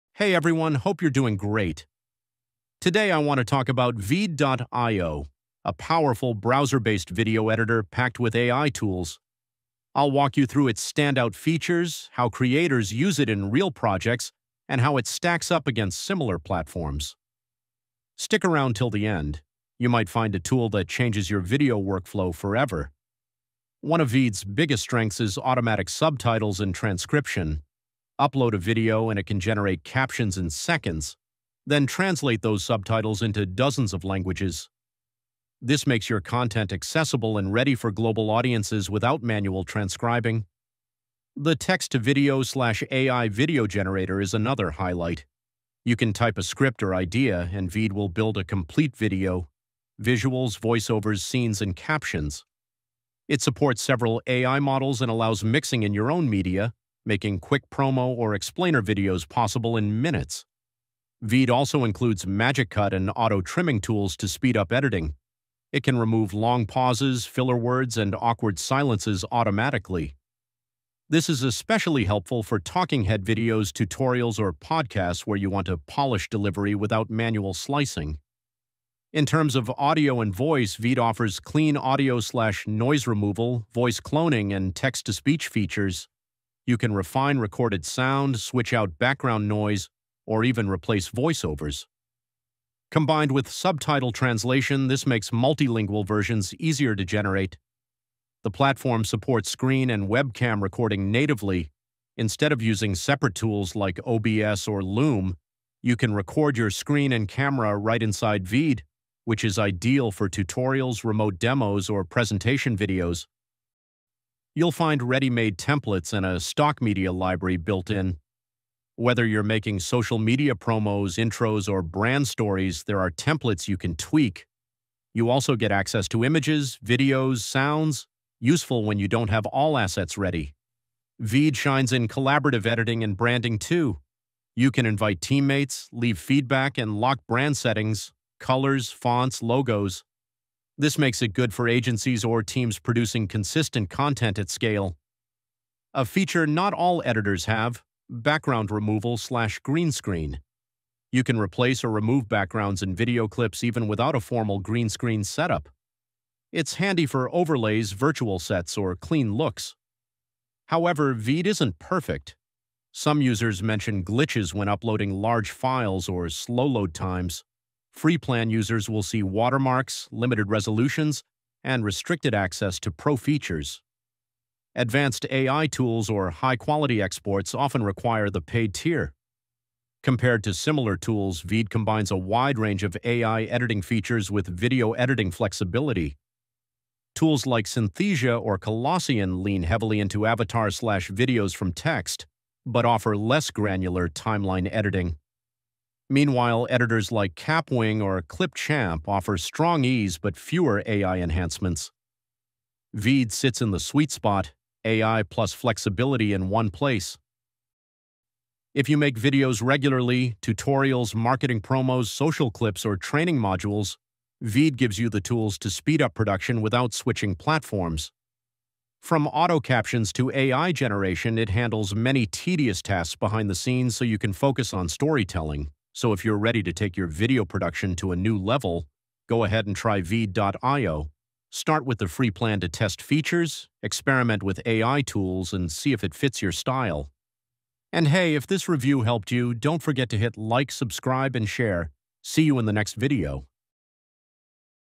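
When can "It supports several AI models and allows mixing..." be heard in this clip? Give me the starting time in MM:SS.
00:53.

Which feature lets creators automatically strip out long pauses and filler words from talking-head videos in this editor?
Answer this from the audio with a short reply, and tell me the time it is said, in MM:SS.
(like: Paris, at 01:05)
Magic Cut, at 01:02.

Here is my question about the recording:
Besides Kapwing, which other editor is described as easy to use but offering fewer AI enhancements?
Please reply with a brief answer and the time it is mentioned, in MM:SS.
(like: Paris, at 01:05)
Clipchamp, at 03:18.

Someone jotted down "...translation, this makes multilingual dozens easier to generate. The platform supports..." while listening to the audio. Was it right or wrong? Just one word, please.
wrong.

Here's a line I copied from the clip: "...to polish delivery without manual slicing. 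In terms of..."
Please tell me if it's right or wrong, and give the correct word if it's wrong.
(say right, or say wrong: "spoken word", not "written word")
right.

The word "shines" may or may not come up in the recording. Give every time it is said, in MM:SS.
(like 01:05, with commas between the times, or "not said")
02:11.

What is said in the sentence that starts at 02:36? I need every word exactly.
It's handy for overlays, virtual sets, or clean looks.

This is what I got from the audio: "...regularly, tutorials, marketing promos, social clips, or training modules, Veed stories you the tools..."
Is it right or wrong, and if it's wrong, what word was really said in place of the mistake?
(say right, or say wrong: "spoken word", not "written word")
wrong: "gives", not "stories".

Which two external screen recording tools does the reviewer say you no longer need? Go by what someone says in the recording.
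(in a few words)
OBS or Loom.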